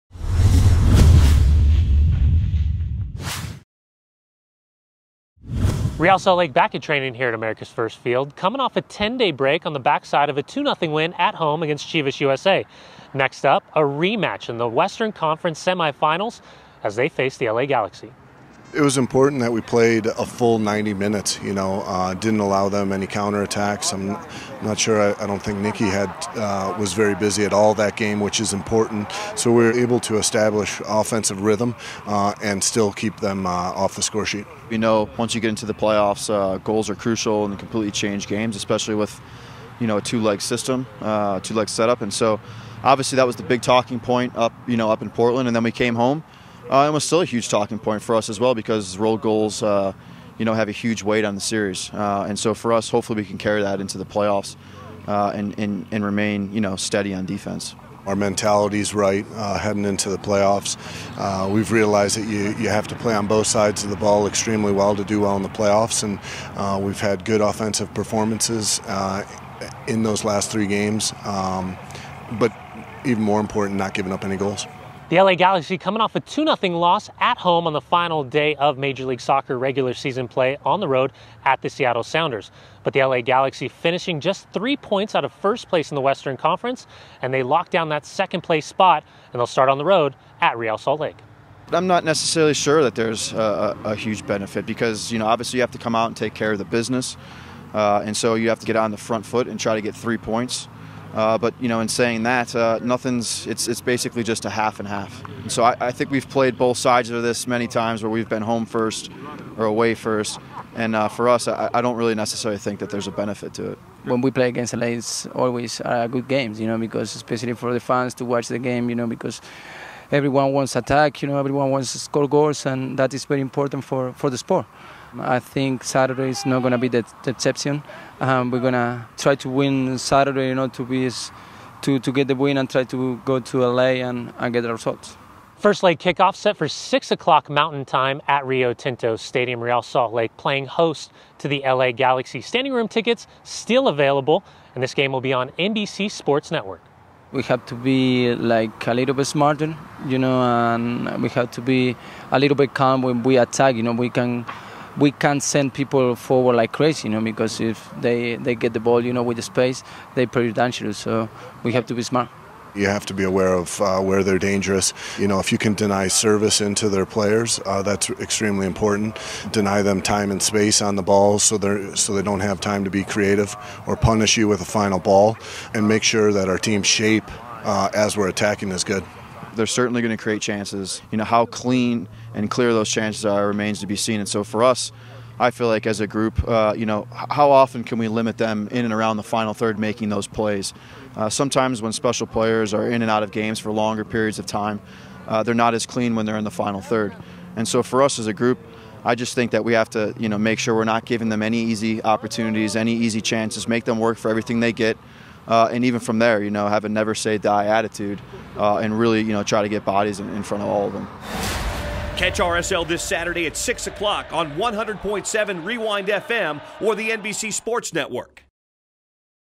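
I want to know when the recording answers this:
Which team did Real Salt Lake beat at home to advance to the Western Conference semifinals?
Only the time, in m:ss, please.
0:11.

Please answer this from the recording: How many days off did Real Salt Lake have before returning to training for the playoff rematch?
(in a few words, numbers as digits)
10.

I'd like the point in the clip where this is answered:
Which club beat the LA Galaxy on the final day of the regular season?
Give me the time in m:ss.
1:21.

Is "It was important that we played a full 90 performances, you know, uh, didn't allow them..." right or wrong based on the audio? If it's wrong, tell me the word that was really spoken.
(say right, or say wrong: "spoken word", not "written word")
wrong: "minutes", not "performances".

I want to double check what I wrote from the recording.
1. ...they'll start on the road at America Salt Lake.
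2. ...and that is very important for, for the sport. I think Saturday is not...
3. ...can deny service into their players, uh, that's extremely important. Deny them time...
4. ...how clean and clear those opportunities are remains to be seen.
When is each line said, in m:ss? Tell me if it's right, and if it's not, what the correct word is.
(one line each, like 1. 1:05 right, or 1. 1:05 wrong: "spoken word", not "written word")
1. 1:29 wrong: "Real", not "America"
2. 2:02 right
3. 2:45 right
4. 3:01 wrong: "chances", not "opportunities".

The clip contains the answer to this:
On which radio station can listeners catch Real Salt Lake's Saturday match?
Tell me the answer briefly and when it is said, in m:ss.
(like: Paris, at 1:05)
100.7 Rewind FM, at 3:34.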